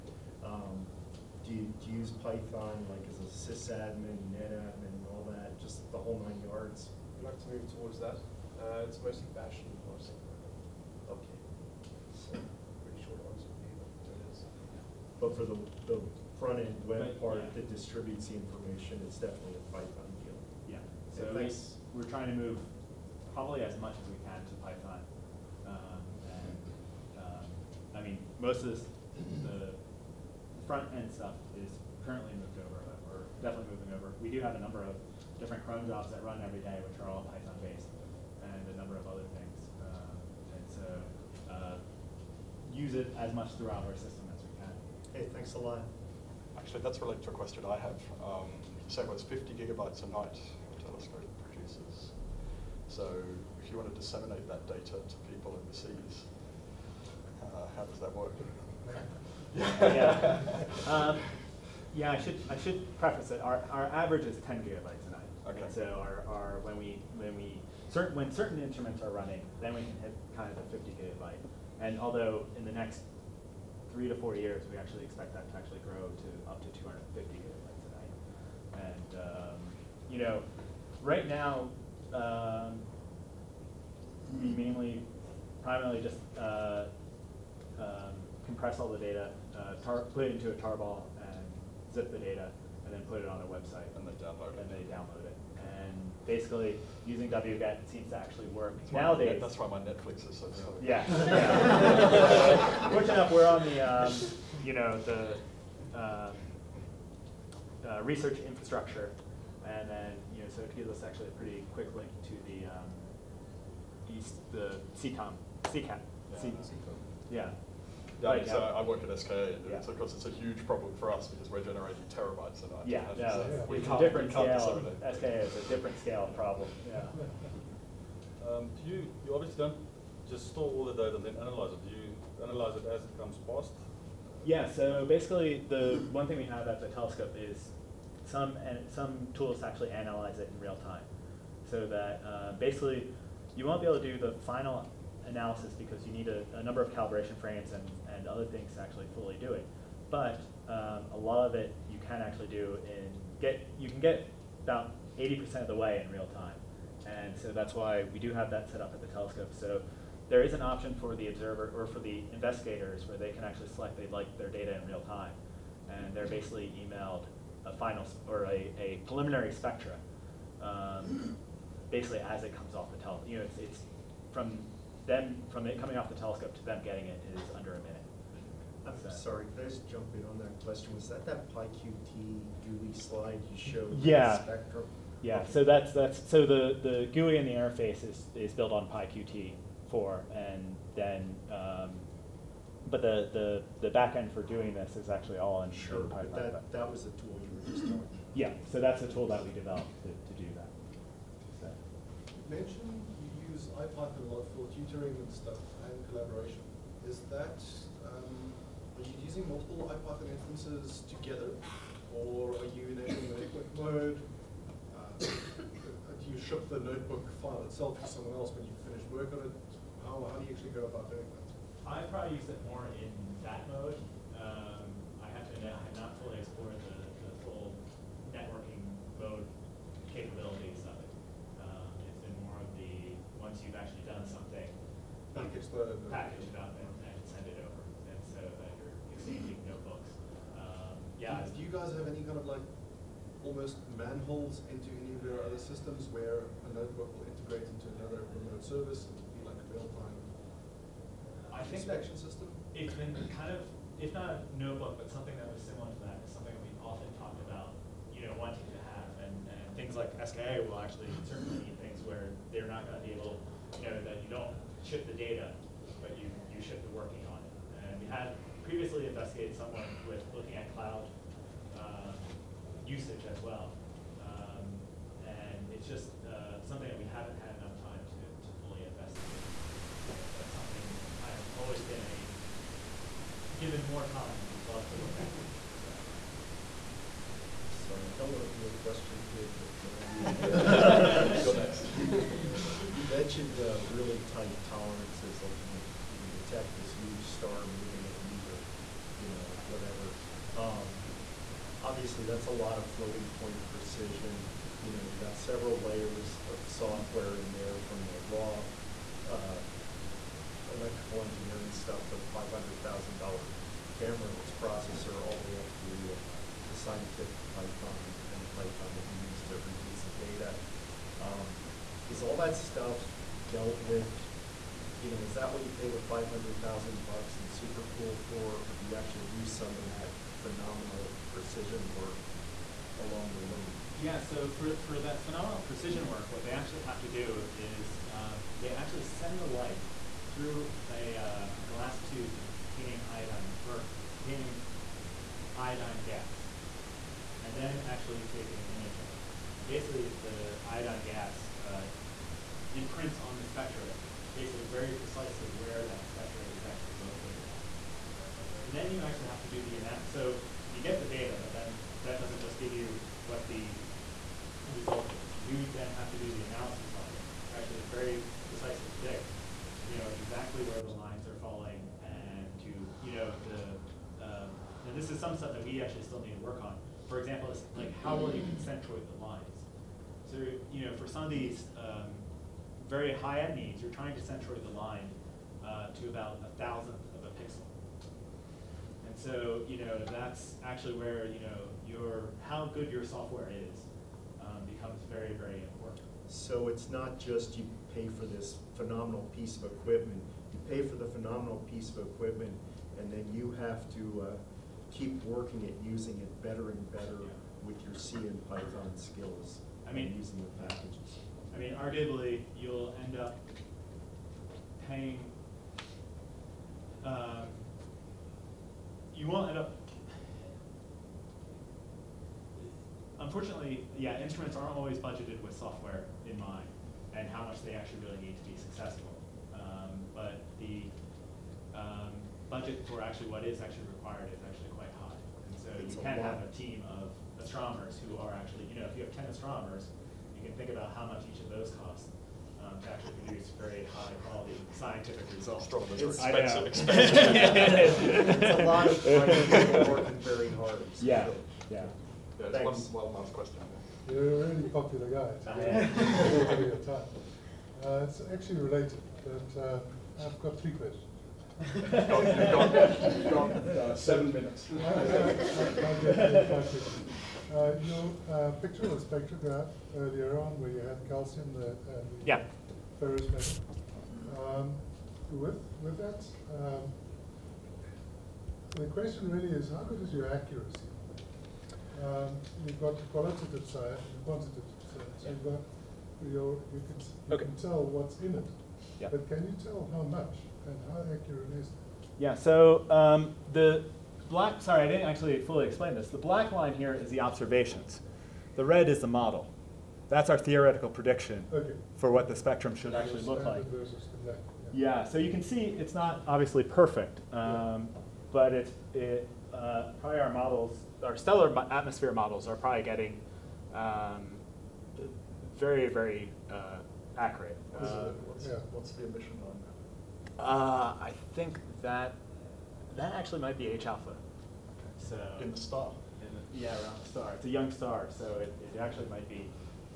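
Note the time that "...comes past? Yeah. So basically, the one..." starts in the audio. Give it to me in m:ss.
2:13.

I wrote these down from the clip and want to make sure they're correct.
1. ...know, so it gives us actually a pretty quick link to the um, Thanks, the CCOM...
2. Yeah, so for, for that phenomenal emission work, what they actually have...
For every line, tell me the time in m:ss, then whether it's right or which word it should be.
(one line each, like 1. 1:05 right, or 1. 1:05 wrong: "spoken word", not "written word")
1. 1:50 wrong: "East", not "Thanks"
2. 5:33 wrong: "precision", not "emission".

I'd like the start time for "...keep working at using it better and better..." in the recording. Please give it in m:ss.
6:44.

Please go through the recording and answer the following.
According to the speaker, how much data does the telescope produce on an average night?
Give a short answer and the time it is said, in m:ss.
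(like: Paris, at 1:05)
10 gigabytes, at 1:04.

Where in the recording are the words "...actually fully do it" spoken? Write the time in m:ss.
2:28.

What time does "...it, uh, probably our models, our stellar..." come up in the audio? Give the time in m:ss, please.
8:28.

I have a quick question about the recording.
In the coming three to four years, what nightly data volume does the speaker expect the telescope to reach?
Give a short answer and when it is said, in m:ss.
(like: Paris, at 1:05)
250 gigabytes, at 1:16.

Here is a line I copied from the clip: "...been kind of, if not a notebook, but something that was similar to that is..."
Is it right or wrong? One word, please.
right.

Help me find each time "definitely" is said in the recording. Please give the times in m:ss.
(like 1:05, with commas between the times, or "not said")
0:19, 0:33.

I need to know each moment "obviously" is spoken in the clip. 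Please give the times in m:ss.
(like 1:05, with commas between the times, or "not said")
2:09, 5:01, 8:26.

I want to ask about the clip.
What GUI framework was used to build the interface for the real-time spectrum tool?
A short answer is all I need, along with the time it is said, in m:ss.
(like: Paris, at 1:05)
PyQt4, at 3:08.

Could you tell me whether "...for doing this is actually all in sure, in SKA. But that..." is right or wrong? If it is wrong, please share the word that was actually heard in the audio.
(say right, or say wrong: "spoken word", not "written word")
wrong: "Python", not "SKA".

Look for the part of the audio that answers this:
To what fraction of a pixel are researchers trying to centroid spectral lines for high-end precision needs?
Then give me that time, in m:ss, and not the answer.
6:26.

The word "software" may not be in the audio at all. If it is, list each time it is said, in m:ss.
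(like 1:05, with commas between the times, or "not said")
5:06, 6:33, 7:05.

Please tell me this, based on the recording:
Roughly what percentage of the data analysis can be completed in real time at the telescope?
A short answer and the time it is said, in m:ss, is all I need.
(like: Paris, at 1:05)
80%, at 2:35.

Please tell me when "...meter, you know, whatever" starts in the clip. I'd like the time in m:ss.
4:58.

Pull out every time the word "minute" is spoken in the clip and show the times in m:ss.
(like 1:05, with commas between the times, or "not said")
2:57, 7:44.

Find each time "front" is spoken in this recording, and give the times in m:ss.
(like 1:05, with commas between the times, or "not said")
0:16, 0:30.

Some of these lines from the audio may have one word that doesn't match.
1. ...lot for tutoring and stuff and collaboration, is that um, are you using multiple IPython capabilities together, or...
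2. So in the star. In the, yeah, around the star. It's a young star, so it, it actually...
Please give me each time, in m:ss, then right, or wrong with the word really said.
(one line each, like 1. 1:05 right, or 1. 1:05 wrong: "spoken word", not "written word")
1. 3:24 wrong: "instances", not "capabilities"
2. 8:44 right.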